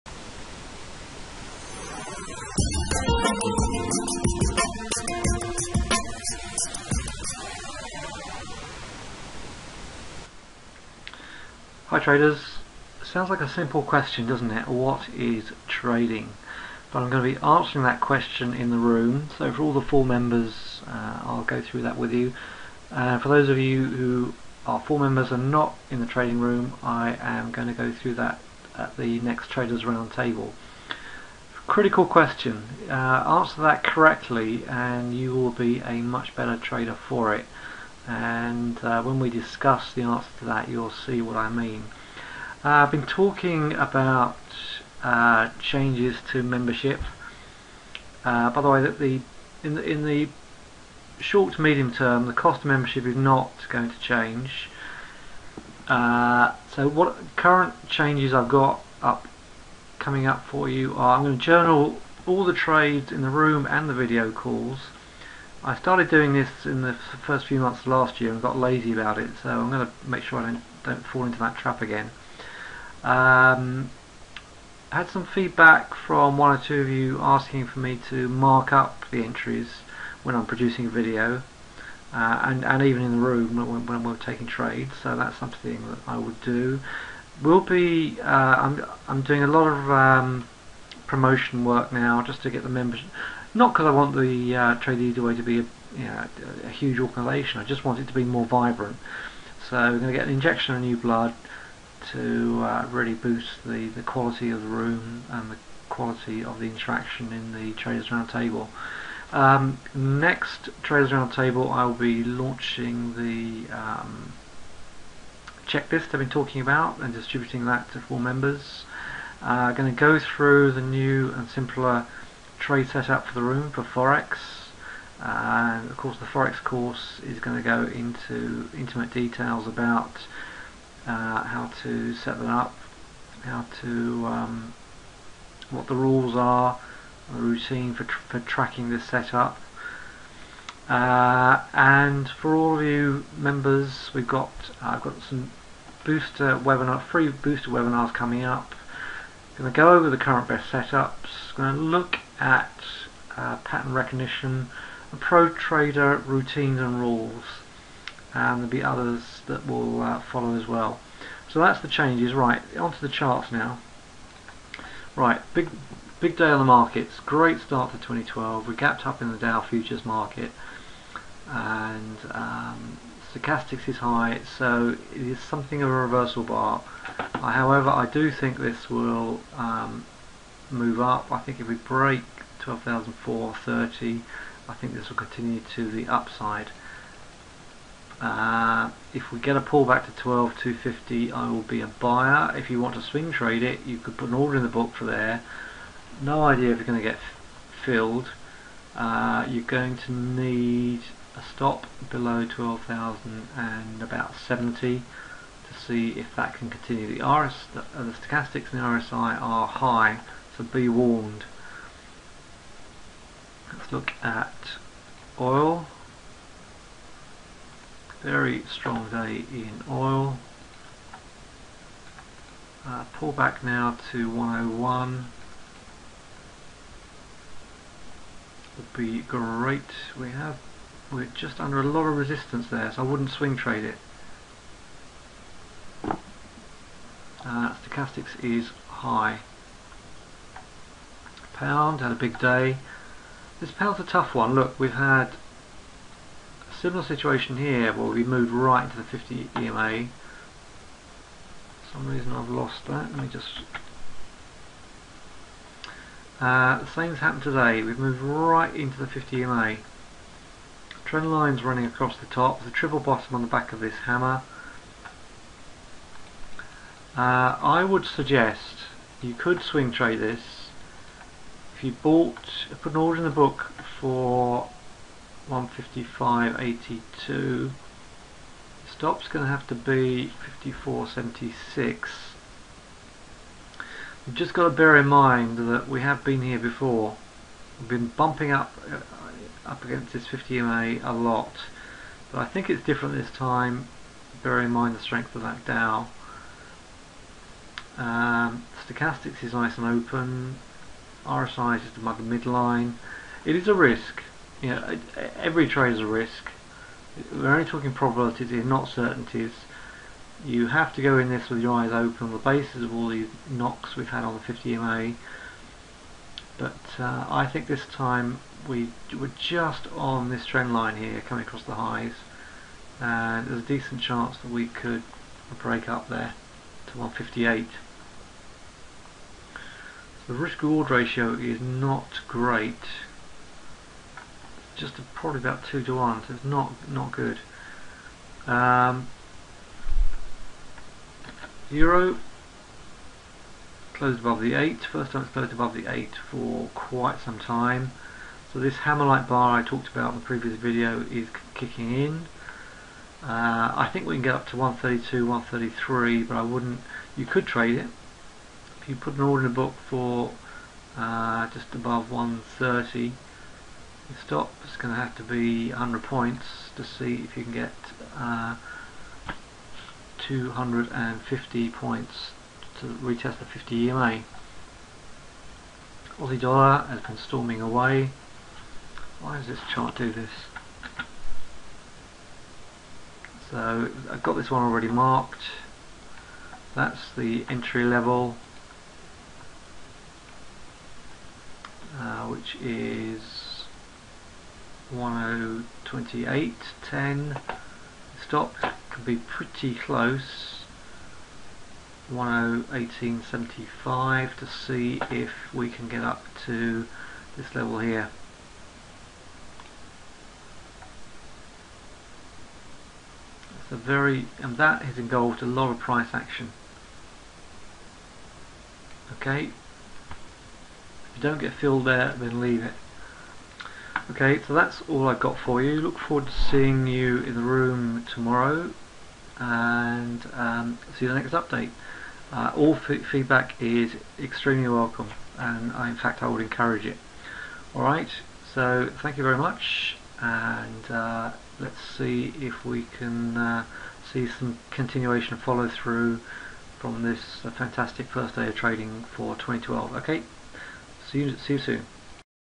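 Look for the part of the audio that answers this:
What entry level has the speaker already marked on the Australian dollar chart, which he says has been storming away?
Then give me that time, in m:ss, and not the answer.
6:34.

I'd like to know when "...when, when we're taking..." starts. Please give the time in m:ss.
1:23.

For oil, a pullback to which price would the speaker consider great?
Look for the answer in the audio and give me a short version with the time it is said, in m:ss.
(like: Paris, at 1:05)
101, at 3:44.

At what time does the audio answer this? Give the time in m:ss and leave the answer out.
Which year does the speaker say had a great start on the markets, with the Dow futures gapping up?
2:47.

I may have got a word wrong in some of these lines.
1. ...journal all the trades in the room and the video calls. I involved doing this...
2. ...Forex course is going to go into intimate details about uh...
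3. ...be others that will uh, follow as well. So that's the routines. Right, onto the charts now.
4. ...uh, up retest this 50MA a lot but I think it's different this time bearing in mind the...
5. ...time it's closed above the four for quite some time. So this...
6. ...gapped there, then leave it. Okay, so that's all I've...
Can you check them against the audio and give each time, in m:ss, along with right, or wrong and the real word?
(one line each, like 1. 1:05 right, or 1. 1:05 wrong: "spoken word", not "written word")
1. 1:01 wrong: "started", not "involved"
2. 2:06 right
3. 2:38 wrong: "changes", not "routines"
4. 4:48 wrong: "against", not "retest"
5. 5:45 wrong: "eight", not "four"
6. 7:01 wrong: "filled", not "gapped".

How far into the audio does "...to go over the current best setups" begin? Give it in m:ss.
2:29.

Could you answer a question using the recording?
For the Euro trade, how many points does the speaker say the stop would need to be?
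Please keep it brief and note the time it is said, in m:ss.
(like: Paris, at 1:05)
100 points, at 6:05.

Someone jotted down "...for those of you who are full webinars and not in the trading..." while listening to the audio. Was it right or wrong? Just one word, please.
wrong.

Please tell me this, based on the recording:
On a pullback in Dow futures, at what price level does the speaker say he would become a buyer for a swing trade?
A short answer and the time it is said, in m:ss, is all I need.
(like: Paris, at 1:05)
12,250, at 3:10.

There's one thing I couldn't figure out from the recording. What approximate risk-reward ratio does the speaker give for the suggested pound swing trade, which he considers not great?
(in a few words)
2 to 1.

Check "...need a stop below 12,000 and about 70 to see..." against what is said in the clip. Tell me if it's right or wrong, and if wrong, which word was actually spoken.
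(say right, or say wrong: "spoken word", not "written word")
right.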